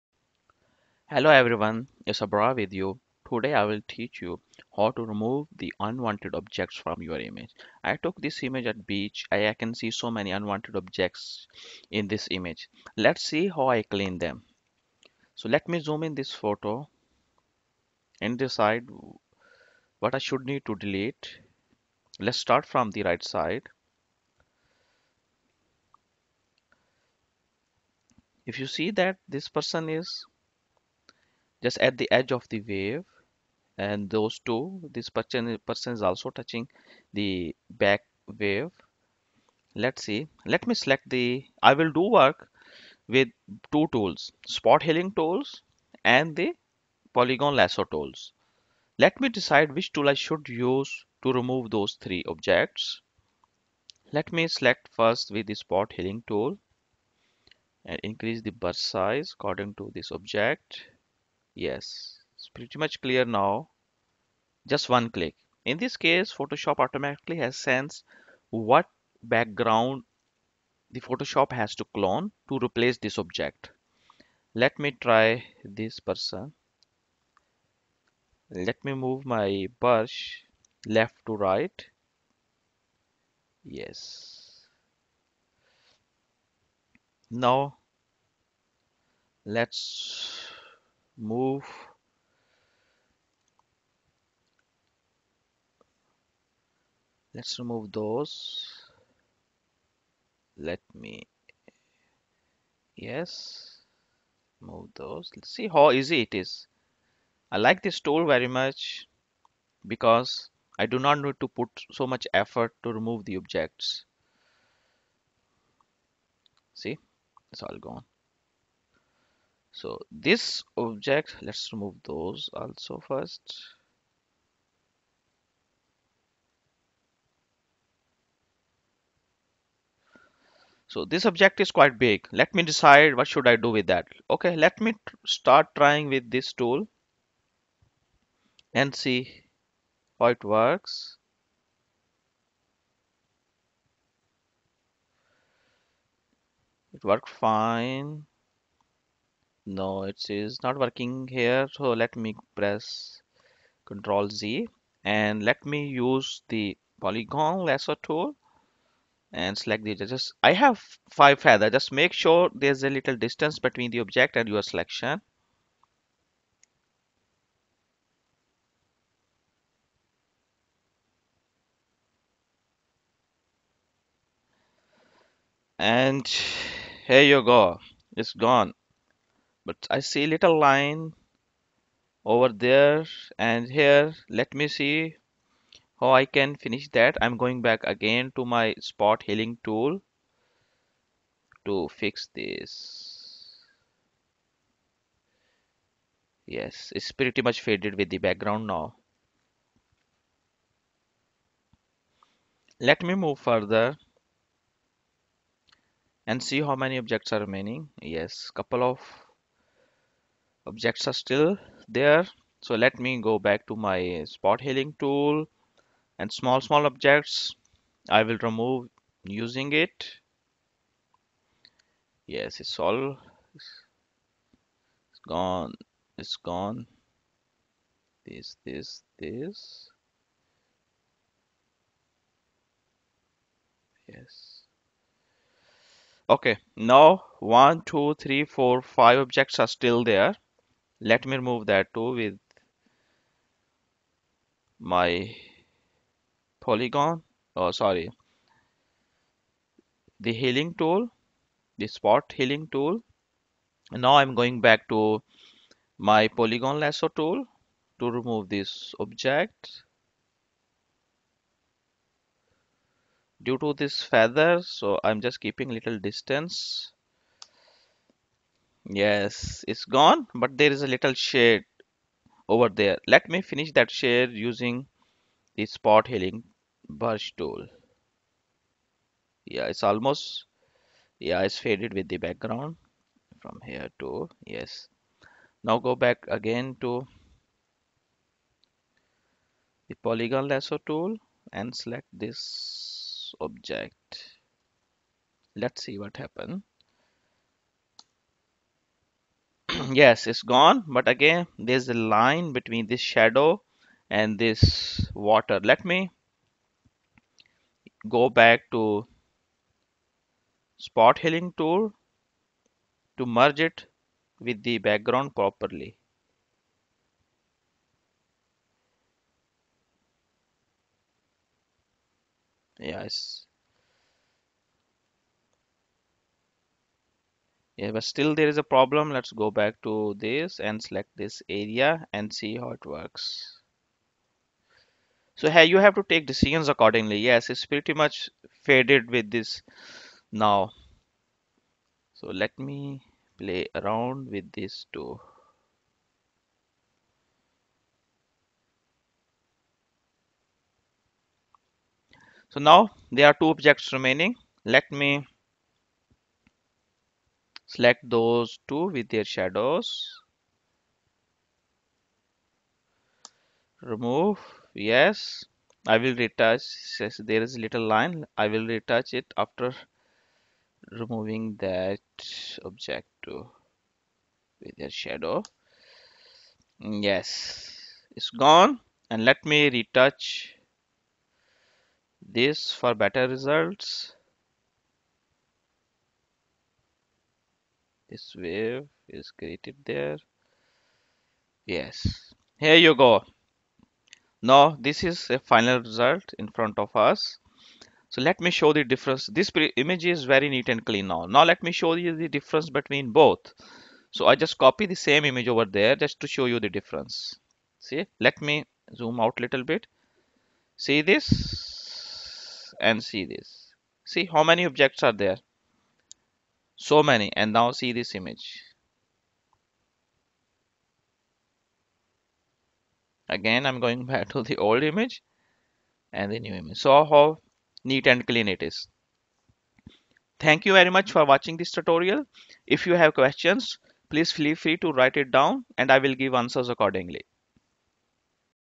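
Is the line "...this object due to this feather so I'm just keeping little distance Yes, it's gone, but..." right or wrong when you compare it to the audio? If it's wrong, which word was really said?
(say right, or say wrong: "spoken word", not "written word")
right.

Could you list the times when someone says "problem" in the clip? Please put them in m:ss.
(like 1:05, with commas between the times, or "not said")
5:28.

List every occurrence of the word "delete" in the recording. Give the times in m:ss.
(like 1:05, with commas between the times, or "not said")
0:20.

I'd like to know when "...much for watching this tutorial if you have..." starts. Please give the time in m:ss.
7:10.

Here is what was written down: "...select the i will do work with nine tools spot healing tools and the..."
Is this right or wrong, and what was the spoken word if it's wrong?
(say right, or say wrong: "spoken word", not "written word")
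wrong: "two", not "nine".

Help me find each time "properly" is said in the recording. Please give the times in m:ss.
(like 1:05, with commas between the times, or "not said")
5:15.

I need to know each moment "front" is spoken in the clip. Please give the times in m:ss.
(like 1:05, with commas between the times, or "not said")
6:36.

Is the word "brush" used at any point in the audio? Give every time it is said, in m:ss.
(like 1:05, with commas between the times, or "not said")
0:58, 1:19, 4:36.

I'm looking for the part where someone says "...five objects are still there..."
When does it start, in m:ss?
3:58.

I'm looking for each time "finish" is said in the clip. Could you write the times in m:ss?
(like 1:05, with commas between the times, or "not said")
3:06, 4:33.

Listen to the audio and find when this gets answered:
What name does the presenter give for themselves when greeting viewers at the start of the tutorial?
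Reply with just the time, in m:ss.
0:02.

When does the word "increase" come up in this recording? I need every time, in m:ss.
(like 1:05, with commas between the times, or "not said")
0:58.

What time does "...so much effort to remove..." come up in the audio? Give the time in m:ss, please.
1:51.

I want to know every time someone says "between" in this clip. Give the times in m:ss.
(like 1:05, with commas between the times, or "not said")
2:43, 5:02, 6:42.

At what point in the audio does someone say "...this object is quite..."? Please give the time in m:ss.
2:11.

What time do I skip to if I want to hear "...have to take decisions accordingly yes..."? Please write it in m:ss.
5:35.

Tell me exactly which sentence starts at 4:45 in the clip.
Now go back again to the polygon lasso tool and select this object.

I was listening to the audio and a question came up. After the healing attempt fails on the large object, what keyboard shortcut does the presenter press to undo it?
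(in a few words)
Control Z.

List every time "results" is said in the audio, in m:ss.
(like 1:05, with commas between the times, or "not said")
6:23, 6:35.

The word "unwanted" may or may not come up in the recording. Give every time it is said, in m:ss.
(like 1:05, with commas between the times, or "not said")
0:05, 0:10.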